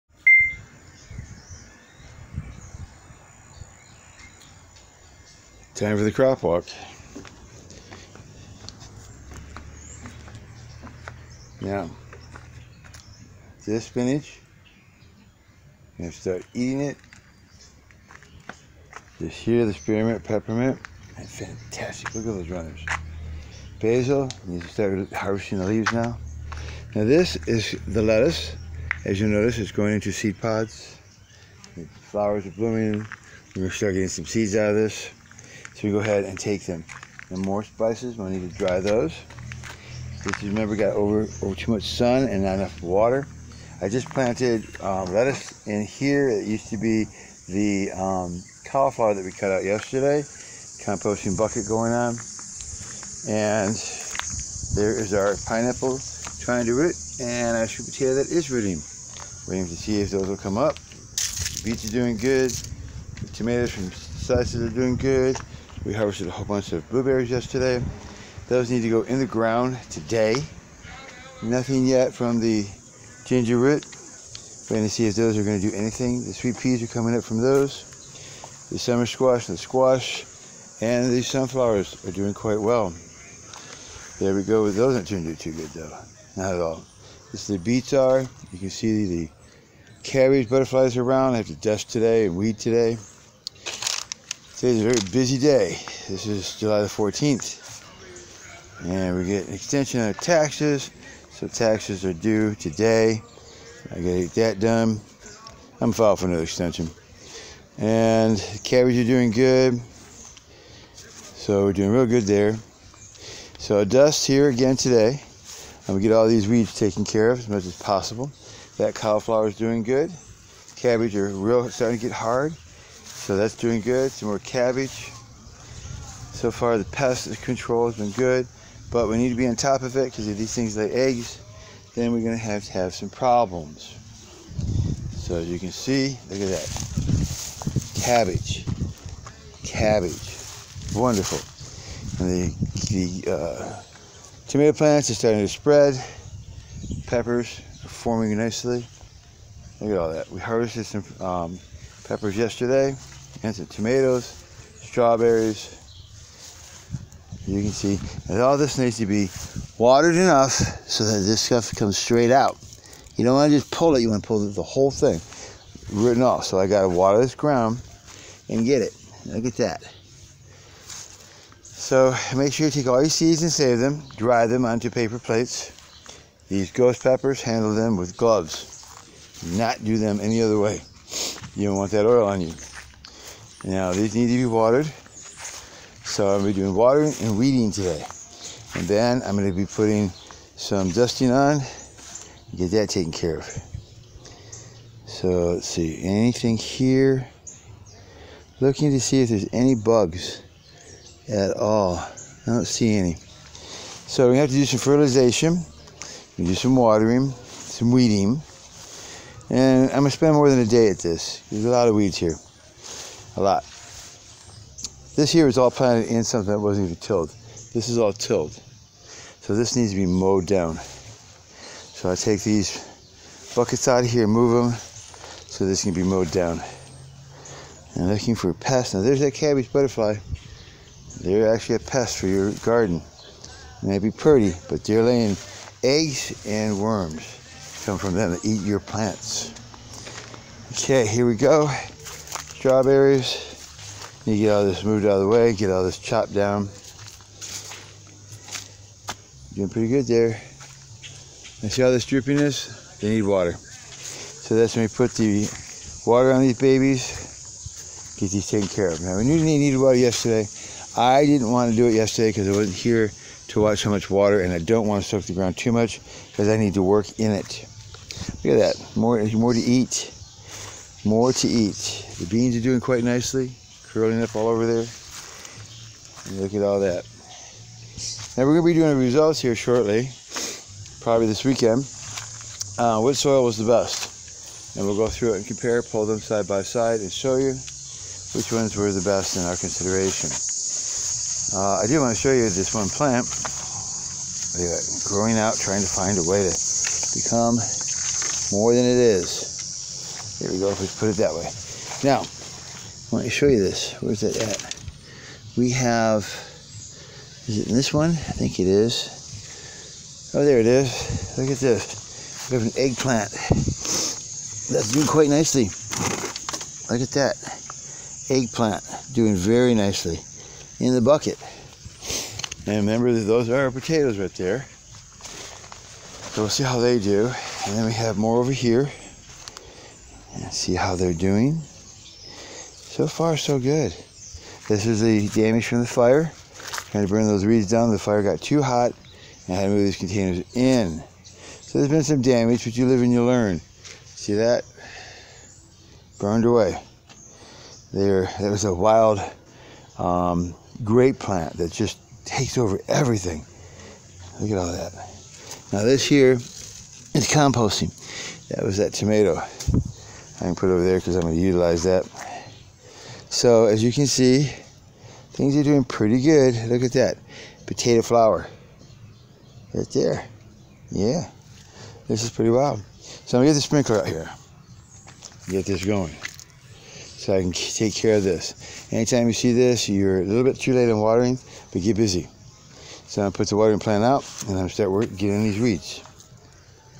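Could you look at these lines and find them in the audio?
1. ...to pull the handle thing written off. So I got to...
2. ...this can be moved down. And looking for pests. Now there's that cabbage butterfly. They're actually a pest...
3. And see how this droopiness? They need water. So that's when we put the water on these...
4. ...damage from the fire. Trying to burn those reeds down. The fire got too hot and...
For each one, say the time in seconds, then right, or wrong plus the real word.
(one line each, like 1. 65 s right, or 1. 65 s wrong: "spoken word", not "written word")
1. 164 s wrong: "whole", not "handle"
2. 225 s wrong: "mowed", not "moved"
3. 251 s right
4. 335 s right.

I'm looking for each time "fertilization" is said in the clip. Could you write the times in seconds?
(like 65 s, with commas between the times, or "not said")
204 s.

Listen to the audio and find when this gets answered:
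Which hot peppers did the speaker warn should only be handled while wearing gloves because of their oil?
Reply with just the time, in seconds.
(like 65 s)
176 s.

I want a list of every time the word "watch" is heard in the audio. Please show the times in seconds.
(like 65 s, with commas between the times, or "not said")
263 s.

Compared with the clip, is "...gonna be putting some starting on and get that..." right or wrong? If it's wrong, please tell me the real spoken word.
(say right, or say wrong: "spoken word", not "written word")
wrong: "dusting", not "starting".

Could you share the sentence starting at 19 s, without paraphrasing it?
This here, the spearmint, peppermint, that's fantastic.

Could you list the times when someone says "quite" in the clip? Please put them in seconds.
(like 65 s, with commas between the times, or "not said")
82 s, 272 s, 315 s.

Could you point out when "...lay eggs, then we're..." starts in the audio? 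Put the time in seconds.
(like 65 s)
130 s.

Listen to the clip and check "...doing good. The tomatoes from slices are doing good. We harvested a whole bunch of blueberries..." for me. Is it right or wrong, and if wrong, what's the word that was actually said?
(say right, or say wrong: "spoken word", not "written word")
right.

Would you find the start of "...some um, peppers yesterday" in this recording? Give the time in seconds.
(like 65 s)
150 s.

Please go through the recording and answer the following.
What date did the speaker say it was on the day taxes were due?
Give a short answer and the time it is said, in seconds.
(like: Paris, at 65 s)
July 14th, at 96 s.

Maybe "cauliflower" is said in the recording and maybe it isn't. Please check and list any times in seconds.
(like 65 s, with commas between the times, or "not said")
48 s, 118 s.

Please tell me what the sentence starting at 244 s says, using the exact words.
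You get all this moved out of the way, get all this chopped down.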